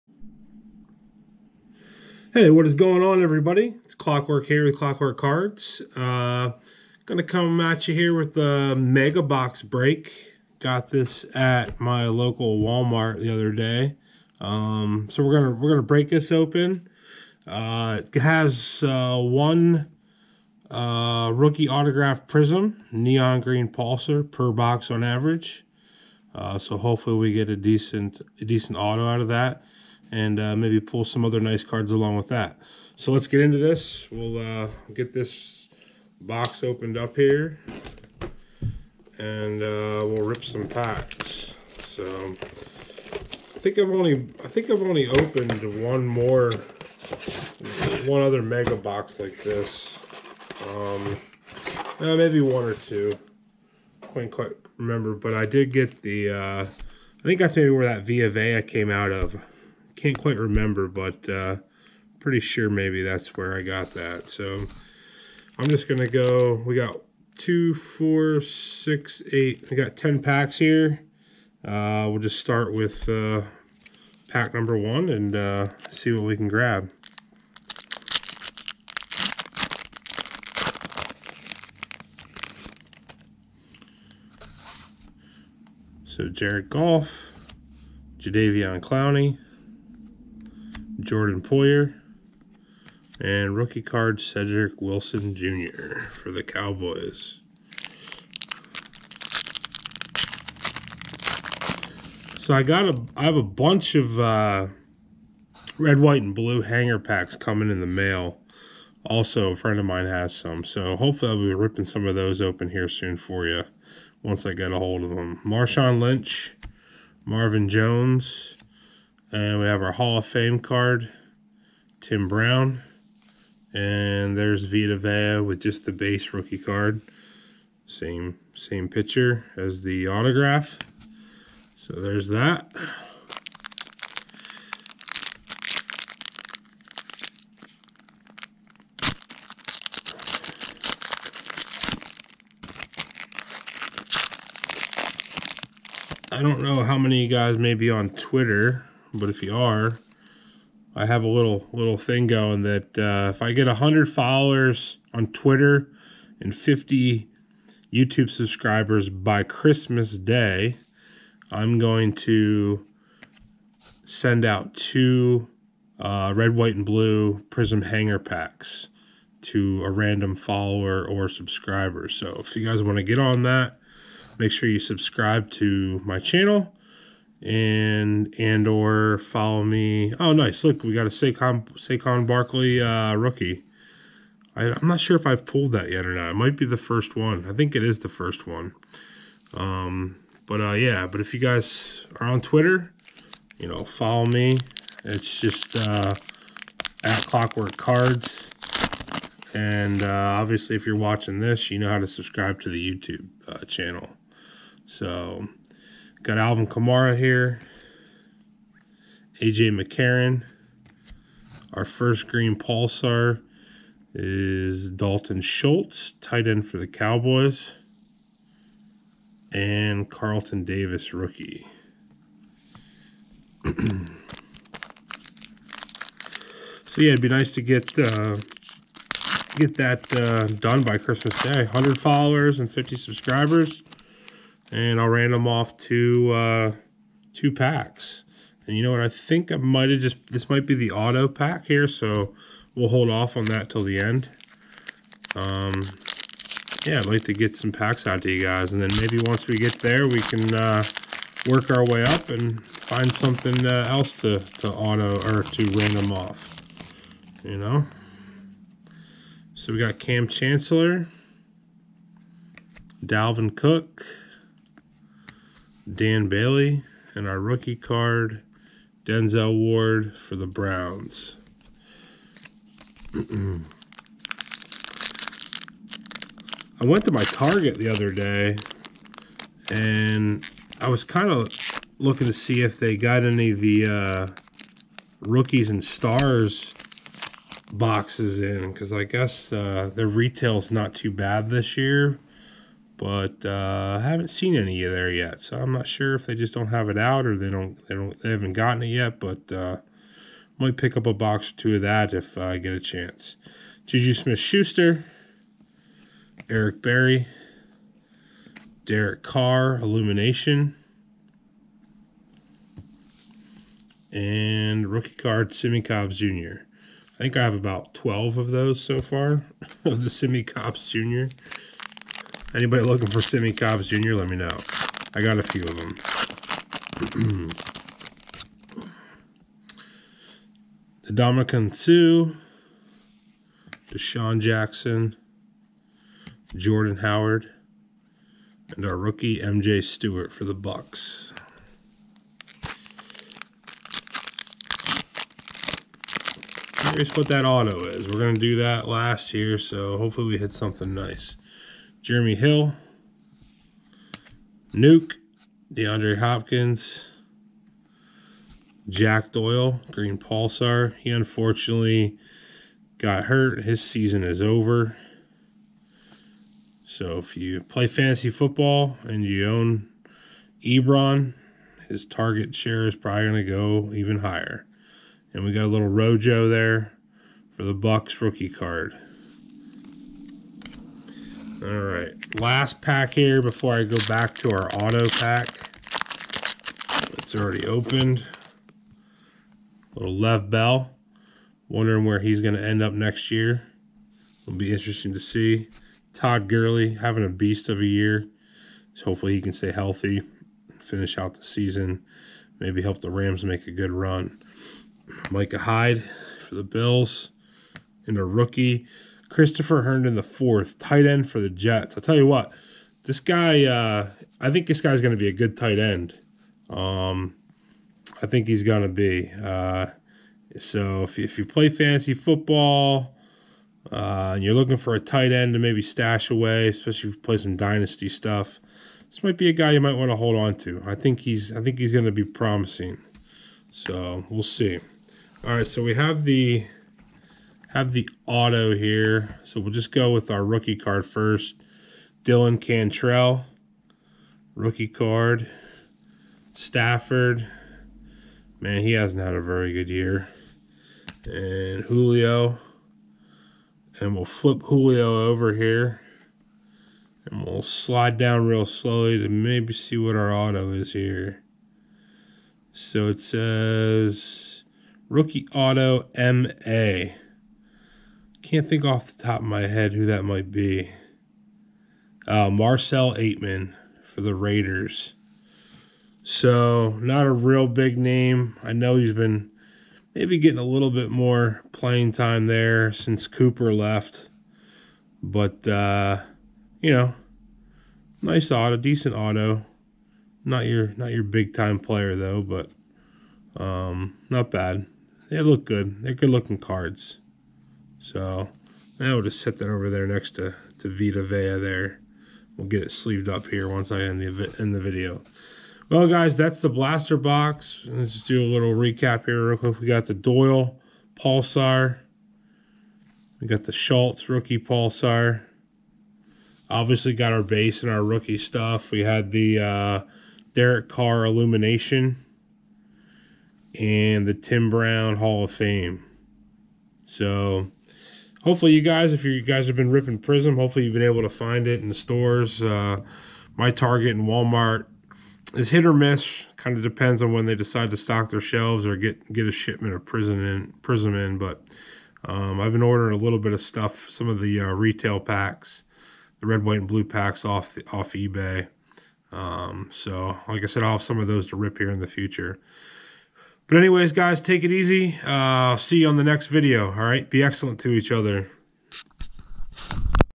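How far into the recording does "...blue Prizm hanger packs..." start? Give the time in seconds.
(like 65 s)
166 s.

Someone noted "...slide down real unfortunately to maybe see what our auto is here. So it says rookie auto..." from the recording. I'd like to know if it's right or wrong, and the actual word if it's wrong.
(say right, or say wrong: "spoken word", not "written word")
wrong: "slowly", not "unfortunately".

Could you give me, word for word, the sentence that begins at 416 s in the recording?
Um, I think he's going to be.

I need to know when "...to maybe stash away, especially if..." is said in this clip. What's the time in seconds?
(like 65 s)
425 s.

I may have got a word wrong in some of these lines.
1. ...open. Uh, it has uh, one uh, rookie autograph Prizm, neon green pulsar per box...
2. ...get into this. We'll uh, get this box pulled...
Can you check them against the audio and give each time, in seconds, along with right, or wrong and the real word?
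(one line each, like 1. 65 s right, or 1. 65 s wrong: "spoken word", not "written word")
1. 16 s right
2. 33 s wrong: "opened", not "pulled".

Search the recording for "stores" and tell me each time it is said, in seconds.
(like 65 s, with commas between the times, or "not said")
531 s.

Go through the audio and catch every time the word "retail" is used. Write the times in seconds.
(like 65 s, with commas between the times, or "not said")
290 s, 544 s.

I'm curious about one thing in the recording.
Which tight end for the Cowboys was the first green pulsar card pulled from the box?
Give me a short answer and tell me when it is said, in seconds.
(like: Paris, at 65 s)
Dalton Schultz, at 214 s.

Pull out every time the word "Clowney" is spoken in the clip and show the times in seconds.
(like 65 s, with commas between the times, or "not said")
88 s.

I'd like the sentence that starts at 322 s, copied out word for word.
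Anybody looking for Simi Cobbs Jr., let me know.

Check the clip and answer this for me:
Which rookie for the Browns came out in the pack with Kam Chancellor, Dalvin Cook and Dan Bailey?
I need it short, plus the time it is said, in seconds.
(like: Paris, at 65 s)
Denzel Ward, at 269 s.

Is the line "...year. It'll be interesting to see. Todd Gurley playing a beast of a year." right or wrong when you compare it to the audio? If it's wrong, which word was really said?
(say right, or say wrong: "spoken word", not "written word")
wrong: "having", not "playing".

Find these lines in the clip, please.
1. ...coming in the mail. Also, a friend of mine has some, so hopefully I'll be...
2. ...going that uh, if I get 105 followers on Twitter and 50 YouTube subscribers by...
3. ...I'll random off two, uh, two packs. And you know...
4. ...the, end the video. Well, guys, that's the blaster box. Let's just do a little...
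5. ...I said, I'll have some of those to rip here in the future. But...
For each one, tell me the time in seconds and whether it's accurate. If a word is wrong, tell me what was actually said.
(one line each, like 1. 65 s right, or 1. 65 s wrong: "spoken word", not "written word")
1. 107 s right
2. 152 s wrong: "100", not "105"
3. 234 s right
4. 504 s right
5. 550 s right.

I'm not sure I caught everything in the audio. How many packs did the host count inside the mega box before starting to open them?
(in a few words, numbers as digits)
10.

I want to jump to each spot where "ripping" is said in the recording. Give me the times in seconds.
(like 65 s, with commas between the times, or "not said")
111 s, 529 s.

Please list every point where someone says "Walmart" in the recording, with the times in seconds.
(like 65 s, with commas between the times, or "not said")
12 s, 534 s.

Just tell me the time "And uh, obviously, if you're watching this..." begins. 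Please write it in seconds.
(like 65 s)
199 s.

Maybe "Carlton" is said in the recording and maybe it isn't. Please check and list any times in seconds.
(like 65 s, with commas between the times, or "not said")
220 s.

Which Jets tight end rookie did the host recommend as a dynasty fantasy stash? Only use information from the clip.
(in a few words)
Christopher Herndon.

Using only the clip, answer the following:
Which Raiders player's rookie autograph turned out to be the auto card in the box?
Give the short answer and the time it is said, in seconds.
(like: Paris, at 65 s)
Marcell Ateman, at 472 s.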